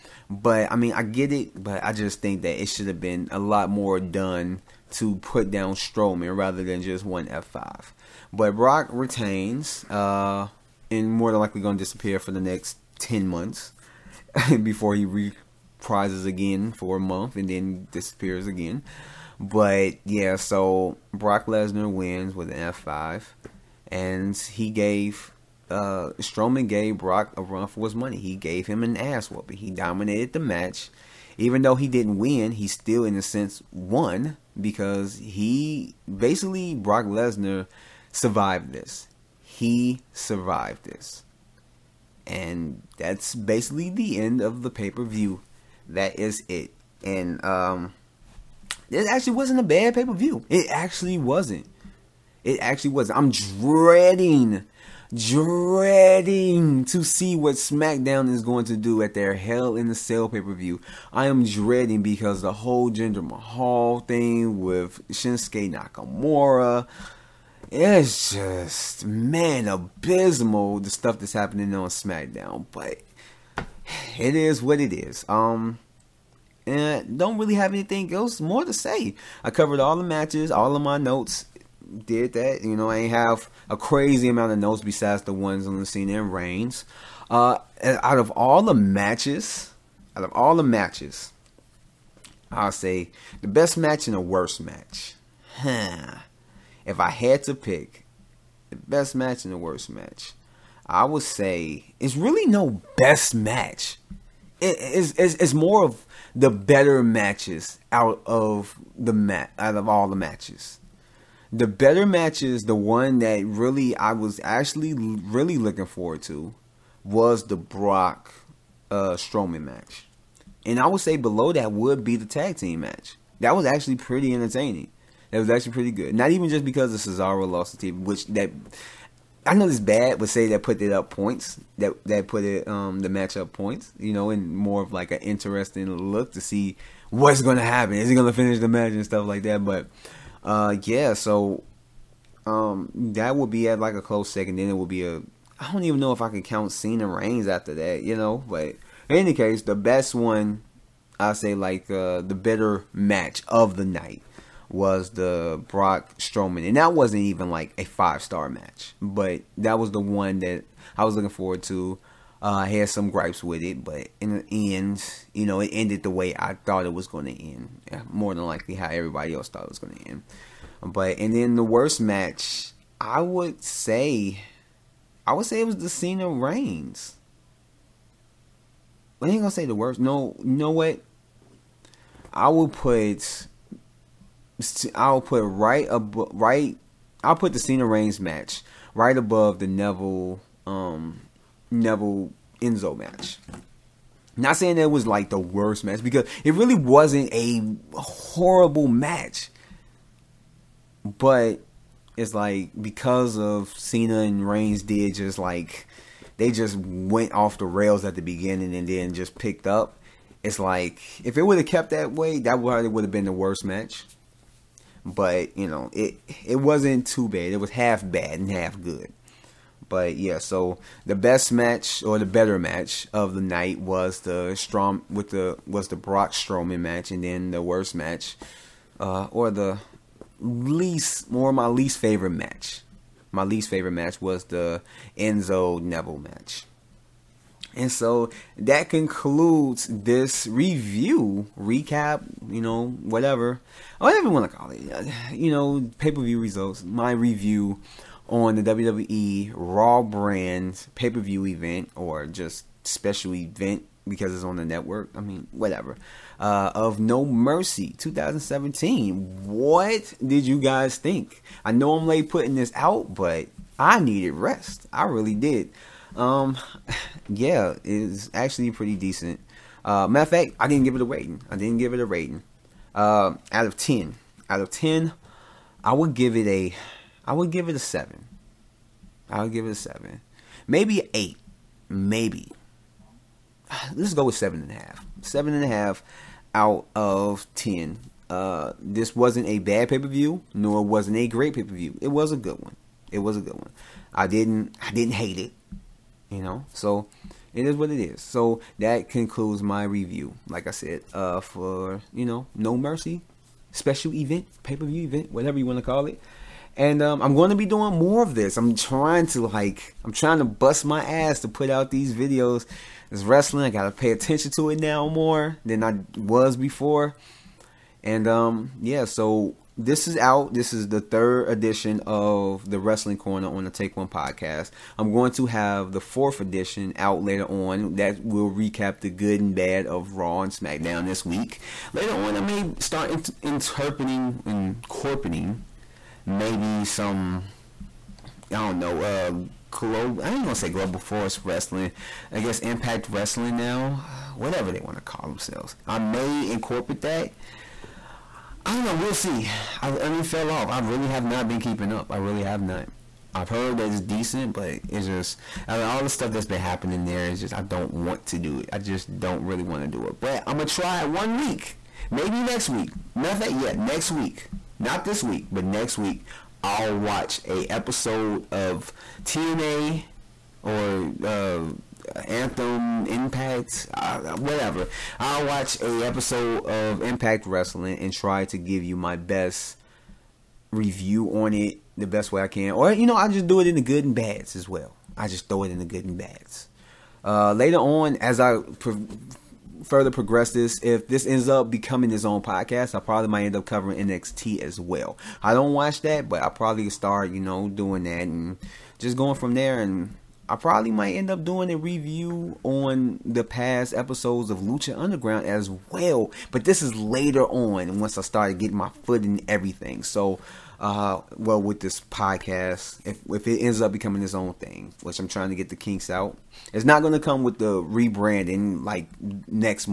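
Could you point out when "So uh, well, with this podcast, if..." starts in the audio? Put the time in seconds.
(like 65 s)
410 s.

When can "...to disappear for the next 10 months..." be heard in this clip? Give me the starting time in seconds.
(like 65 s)
11 s.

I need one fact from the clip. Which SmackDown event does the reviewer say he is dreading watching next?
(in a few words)
Hell in the Cell.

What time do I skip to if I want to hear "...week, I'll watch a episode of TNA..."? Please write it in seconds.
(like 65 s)
365 s.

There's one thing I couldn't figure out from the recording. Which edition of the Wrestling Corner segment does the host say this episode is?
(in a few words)
Third.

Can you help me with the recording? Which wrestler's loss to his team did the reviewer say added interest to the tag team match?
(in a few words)
Cesaro.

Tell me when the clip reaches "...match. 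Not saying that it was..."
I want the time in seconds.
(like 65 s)
192 s.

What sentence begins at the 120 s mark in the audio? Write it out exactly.
And I would say below that would be the tag team match.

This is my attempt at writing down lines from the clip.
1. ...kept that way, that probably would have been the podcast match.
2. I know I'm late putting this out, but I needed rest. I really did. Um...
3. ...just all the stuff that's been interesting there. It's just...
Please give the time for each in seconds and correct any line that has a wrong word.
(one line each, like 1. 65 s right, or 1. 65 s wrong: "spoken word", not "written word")
1. 211 s wrong: "worst", not "podcast"
2. 261 s right
3. 355 s wrong: "happening", not "interesting".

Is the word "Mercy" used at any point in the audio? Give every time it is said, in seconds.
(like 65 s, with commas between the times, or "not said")
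257 s, 302 s.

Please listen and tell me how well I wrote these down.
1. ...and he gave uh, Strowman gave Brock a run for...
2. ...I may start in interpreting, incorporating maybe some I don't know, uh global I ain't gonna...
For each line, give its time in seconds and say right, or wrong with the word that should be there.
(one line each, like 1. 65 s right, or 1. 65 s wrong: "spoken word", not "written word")
1. 23 s right
2. 332 s right.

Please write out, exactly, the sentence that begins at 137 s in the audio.
Is he gonna finish the match and stuff like that?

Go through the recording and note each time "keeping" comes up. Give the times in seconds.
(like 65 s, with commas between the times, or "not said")
351 s.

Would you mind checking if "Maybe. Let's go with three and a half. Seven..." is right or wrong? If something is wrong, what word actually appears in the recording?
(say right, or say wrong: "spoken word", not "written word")
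wrong: "seven", not "three".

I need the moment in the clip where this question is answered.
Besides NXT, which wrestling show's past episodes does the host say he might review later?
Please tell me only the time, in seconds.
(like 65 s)
404 s.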